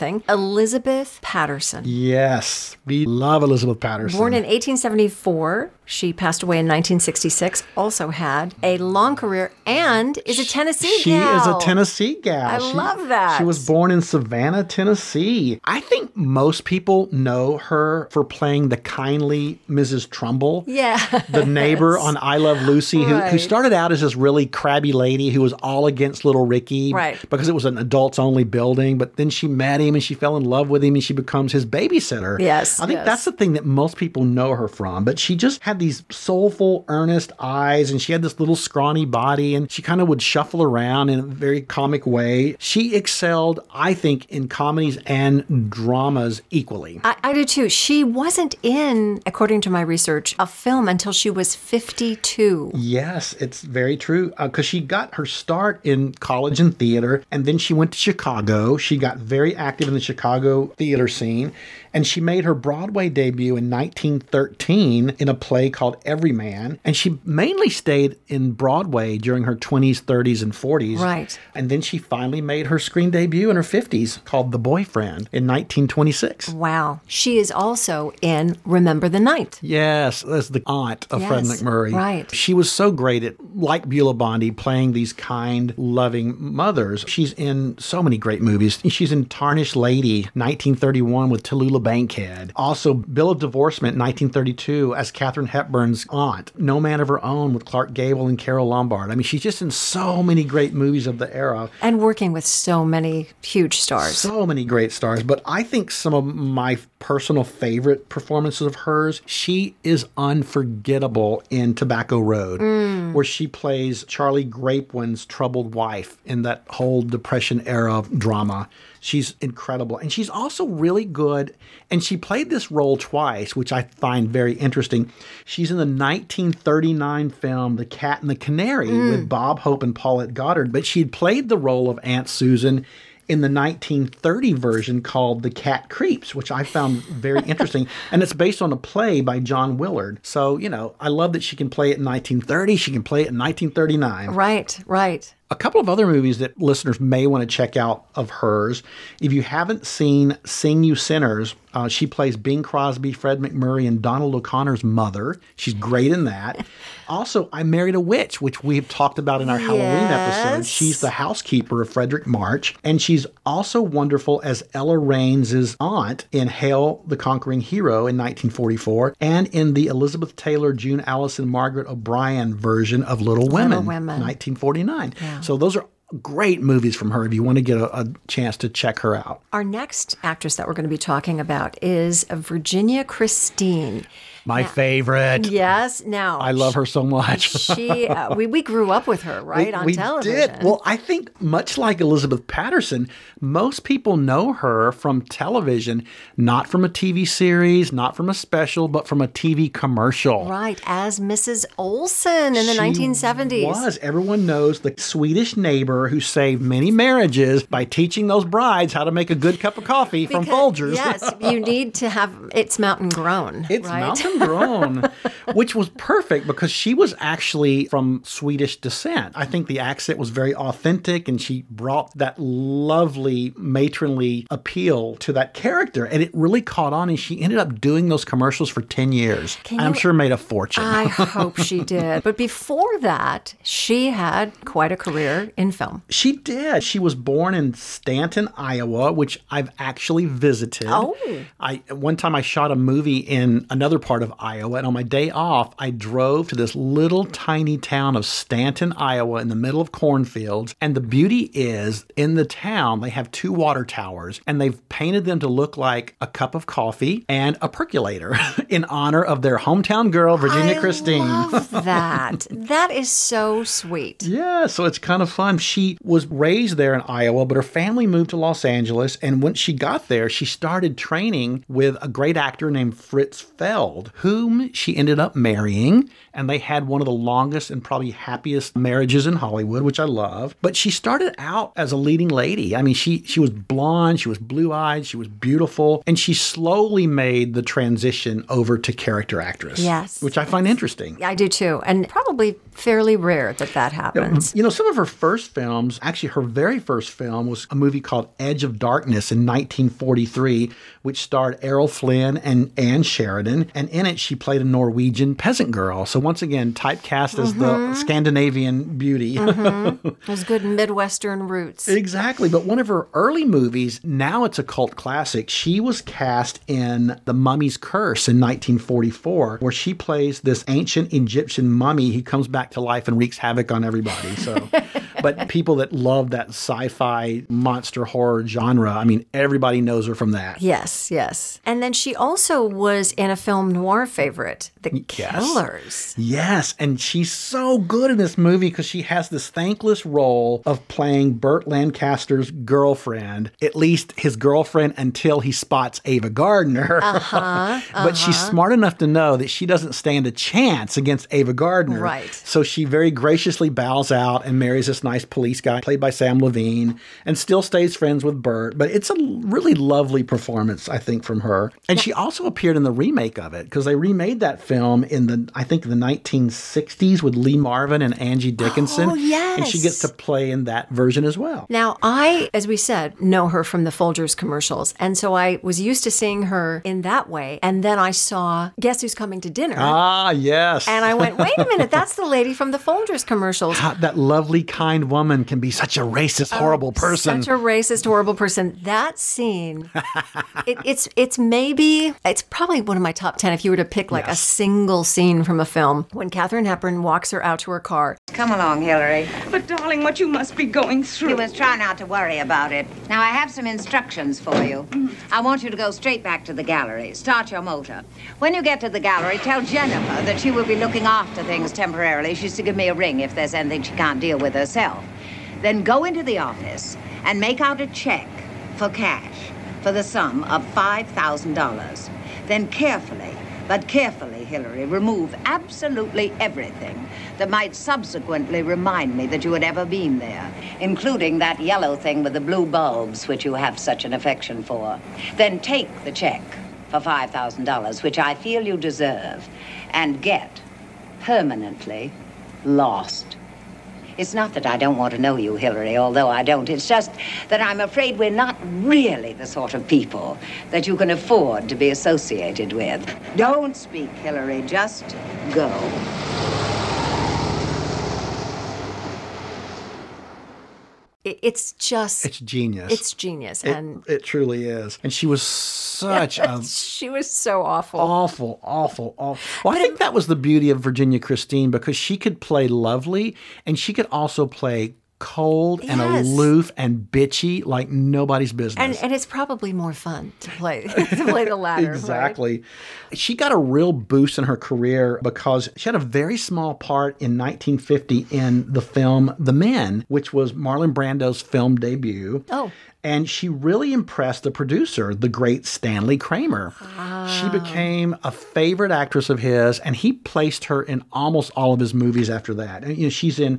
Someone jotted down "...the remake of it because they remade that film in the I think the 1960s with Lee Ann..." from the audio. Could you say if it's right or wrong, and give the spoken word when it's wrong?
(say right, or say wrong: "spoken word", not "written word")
wrong: "Marvin", not "Ann".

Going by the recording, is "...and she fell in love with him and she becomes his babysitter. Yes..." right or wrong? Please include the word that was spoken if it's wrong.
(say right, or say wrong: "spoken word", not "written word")
right.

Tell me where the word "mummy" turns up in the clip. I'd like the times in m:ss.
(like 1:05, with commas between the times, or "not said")
5:17, 5:21.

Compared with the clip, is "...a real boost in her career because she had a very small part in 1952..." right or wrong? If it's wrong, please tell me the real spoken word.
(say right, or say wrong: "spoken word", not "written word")
wrong: "1950", not "1952".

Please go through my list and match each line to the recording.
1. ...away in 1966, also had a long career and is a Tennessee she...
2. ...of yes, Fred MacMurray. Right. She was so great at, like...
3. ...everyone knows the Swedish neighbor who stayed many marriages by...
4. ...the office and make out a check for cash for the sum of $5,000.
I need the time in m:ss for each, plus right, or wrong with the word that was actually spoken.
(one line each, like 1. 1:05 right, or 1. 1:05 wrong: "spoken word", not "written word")
1. 0:06 right
2. 1:21 right
3. 3:23 wrong: "saved", not "stayed"
4. 6:56 right.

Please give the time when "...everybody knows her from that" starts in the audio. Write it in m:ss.
5:29.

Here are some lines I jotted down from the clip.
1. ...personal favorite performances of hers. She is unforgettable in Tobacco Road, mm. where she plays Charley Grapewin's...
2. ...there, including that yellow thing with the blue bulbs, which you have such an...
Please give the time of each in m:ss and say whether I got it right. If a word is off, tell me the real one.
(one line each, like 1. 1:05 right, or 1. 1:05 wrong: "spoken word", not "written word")
1. 1:46 right
2. 7:10 right.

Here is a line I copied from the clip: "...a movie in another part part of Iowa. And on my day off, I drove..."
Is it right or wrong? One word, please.
right.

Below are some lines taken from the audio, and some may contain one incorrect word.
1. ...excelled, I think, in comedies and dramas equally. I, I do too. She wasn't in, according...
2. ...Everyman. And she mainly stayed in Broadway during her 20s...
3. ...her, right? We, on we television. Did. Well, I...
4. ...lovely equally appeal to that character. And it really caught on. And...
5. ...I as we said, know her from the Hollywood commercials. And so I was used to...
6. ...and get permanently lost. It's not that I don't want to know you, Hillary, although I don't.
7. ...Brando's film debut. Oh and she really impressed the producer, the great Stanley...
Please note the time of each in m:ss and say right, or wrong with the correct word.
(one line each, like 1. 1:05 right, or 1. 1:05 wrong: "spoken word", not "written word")
1. 0:42 right
2. 1:06 right
3. 3:09 right
4. 3:42 wrong: "matronly", not "equally"
5. 6:12 wrong: "Folgers", not "Hollywood"
6. 7:19 right
7. 8:10 right.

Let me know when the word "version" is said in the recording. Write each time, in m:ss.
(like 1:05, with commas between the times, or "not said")
2:14, 2:52, 6:10.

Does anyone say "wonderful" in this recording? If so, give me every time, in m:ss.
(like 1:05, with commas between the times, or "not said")
2:43.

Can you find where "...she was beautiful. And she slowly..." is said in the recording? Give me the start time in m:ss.
4:45.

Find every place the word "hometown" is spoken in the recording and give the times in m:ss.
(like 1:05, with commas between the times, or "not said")
4:19.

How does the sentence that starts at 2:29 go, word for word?
If you haven't seen Sing You Sinners, uh, she plays Bing Crosby, Fred MacMurray, and Donald O'Connor's mother.